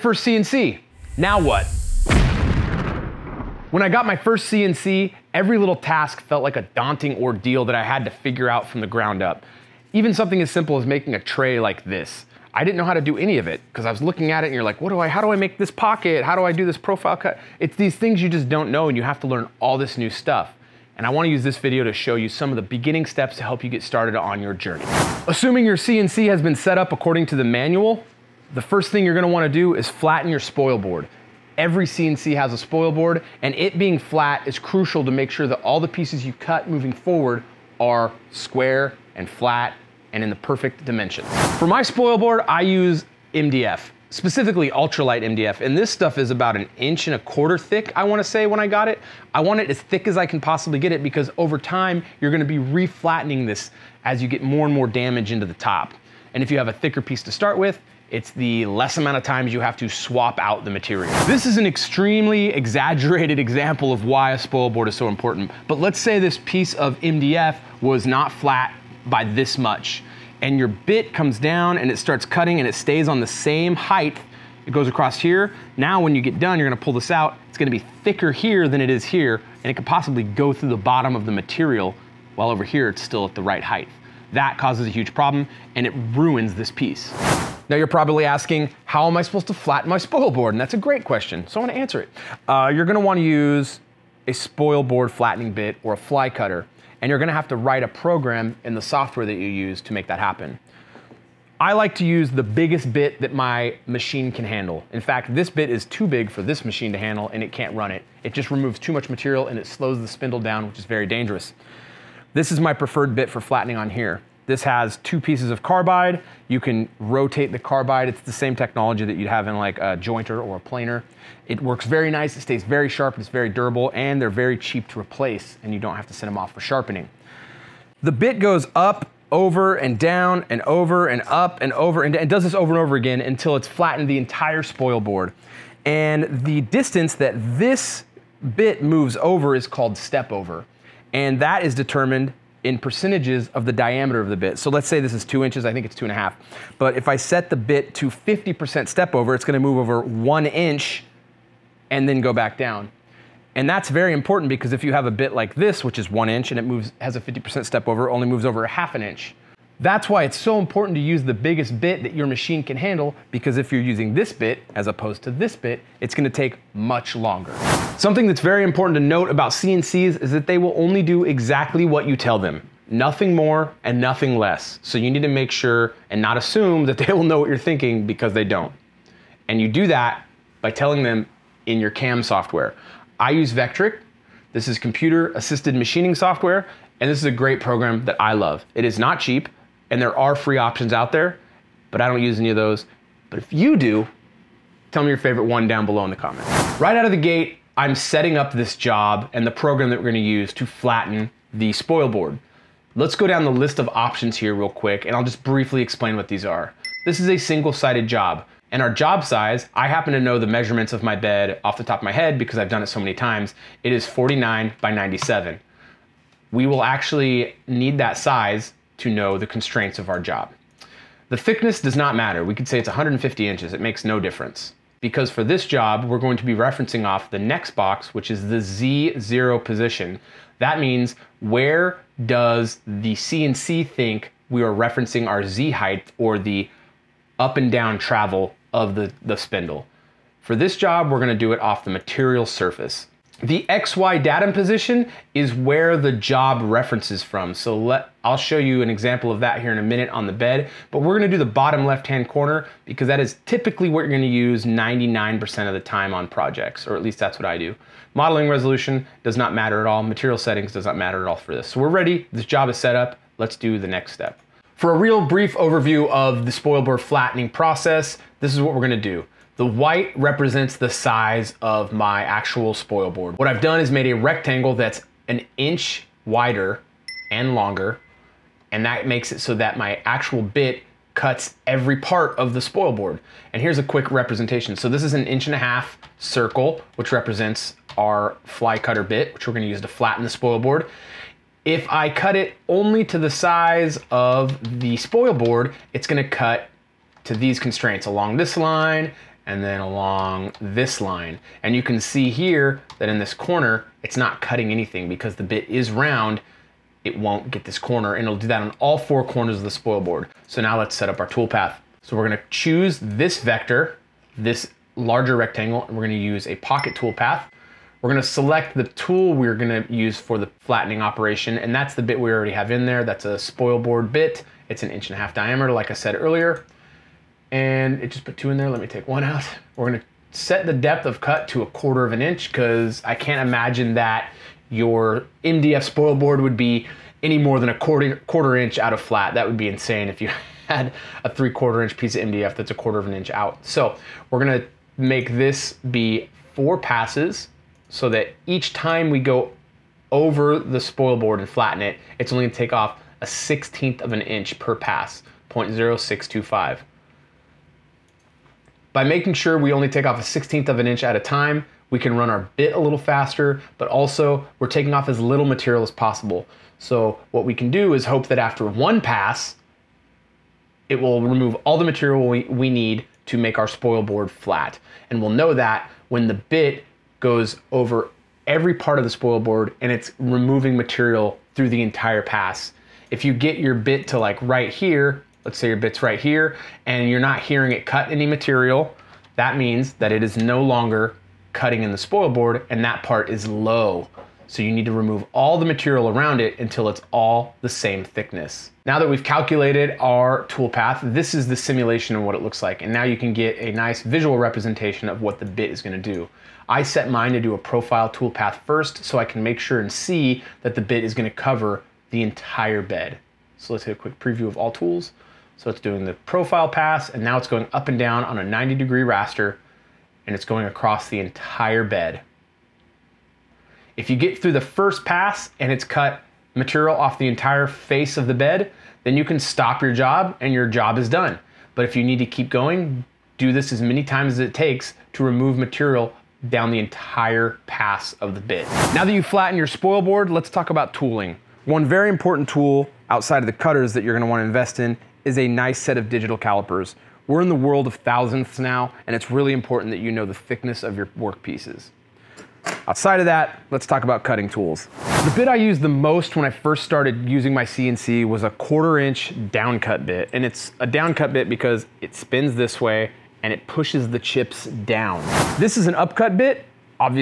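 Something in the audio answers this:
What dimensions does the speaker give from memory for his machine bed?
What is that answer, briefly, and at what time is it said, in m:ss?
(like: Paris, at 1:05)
49 by 97, at 3:34.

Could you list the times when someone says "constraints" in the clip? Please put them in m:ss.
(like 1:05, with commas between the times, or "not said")
3:39, 4:57.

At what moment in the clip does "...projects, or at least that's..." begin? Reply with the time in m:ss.
4:16.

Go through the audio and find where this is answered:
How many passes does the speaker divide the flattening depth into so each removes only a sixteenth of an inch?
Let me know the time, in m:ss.
5:46.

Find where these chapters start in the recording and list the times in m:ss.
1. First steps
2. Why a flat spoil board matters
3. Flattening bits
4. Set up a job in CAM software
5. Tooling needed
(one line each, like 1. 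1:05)
1. 0:25
2. 1:04
3. 1:36
4. 2:51
5. 7:21.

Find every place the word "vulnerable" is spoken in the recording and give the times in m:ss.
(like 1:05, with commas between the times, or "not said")
not said.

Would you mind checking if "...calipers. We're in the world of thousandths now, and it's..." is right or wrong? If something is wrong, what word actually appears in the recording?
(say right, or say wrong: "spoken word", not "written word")
right.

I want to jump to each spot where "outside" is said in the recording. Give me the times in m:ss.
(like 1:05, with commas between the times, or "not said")
7:23, 7:32.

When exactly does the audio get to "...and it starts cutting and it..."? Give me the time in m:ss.
1:11.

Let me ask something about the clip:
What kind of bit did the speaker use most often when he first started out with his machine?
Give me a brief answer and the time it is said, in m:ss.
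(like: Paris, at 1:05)
Quarter inch downcut bit, at 7:38.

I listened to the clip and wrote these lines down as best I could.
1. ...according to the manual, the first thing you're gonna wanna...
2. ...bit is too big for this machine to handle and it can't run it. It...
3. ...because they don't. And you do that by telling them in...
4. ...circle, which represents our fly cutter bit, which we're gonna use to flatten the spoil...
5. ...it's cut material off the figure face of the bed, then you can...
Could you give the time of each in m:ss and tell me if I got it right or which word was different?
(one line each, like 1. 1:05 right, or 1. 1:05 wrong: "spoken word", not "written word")
1. 0:26 right
2. 1:45 right
3. 2:58 right
4. 4:46 right
5. 7:05 wrong: "entire", not "figure".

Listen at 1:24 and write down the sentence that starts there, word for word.
That causes a huge problem and it ruins this piece.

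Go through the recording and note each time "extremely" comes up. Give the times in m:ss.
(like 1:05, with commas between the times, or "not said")
1:01.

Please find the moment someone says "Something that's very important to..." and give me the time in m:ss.
2:47.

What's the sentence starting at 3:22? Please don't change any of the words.
Let's go down the list of options here real quick and I'll just briefly explain what these are.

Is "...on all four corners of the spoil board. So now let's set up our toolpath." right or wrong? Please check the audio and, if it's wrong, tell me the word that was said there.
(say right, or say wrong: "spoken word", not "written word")
right.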